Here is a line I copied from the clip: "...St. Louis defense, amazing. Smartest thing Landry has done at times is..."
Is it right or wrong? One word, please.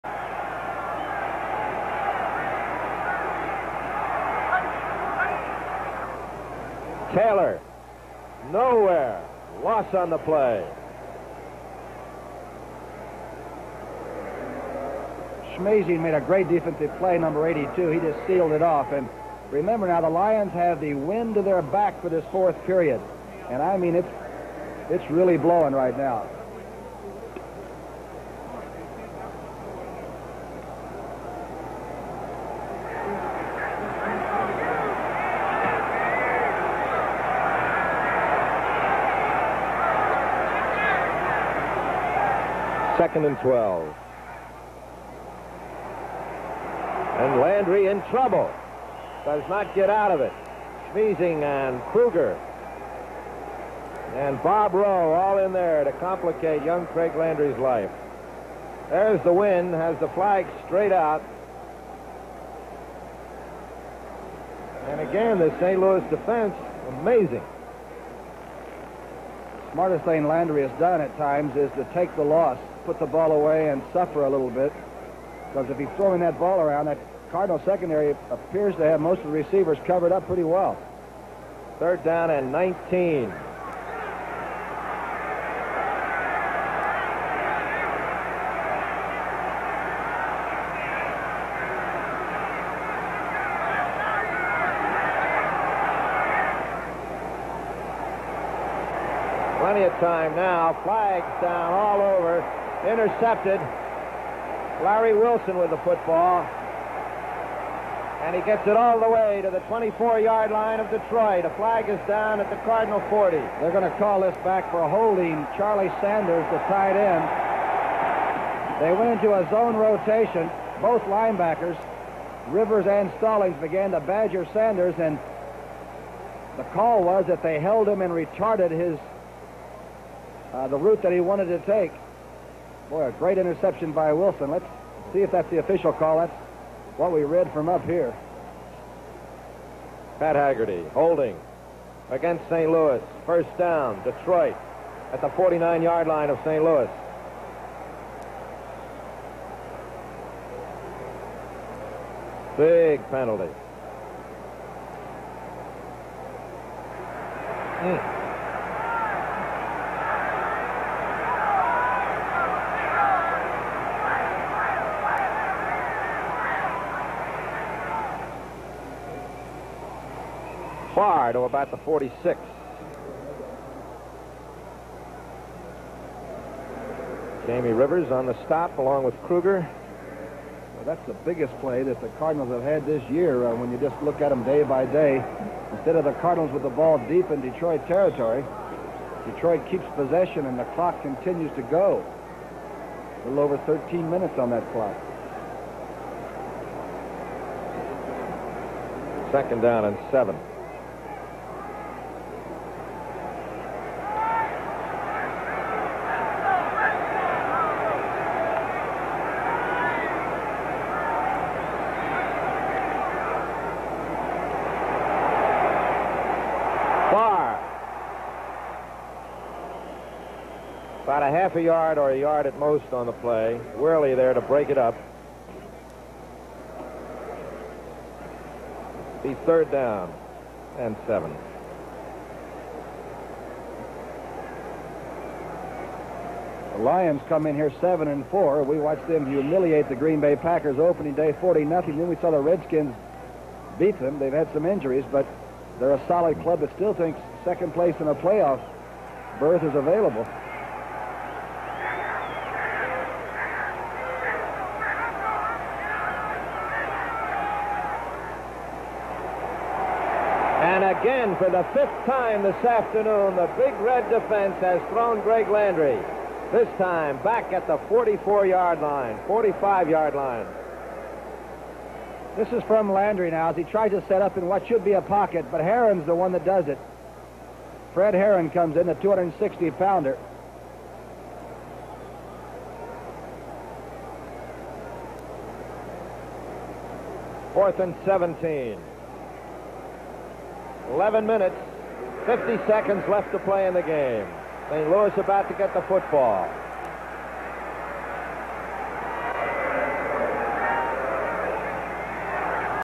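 right.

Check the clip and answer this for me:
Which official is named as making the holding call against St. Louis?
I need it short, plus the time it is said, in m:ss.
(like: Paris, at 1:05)
Pat Haggerty, at 2:20.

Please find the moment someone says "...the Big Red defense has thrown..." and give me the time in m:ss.
4:23.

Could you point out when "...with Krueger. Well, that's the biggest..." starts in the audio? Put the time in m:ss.
2:59.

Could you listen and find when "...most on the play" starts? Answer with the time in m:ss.
3:42.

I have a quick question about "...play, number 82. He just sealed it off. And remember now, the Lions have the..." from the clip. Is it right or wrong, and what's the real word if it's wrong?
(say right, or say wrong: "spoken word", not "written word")
right.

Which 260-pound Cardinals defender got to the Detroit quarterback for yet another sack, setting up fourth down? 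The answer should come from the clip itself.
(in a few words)
Fred Heron.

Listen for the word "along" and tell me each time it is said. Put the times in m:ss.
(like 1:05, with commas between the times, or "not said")
2:58.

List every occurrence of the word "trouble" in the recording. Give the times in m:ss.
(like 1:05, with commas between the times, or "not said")
0:48.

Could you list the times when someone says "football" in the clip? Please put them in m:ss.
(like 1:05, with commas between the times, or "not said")
1:45, 4:55.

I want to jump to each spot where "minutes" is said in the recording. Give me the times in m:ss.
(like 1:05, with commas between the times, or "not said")
3:14, 4:51.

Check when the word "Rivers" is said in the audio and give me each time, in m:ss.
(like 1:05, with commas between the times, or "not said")
2:02, 2:57.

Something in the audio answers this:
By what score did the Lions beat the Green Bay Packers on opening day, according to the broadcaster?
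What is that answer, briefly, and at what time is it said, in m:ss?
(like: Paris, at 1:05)
40-0, at 4:01.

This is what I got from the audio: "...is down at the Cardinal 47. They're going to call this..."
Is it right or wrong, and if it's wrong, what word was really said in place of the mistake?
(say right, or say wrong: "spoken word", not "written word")
wrong: "40", not "47".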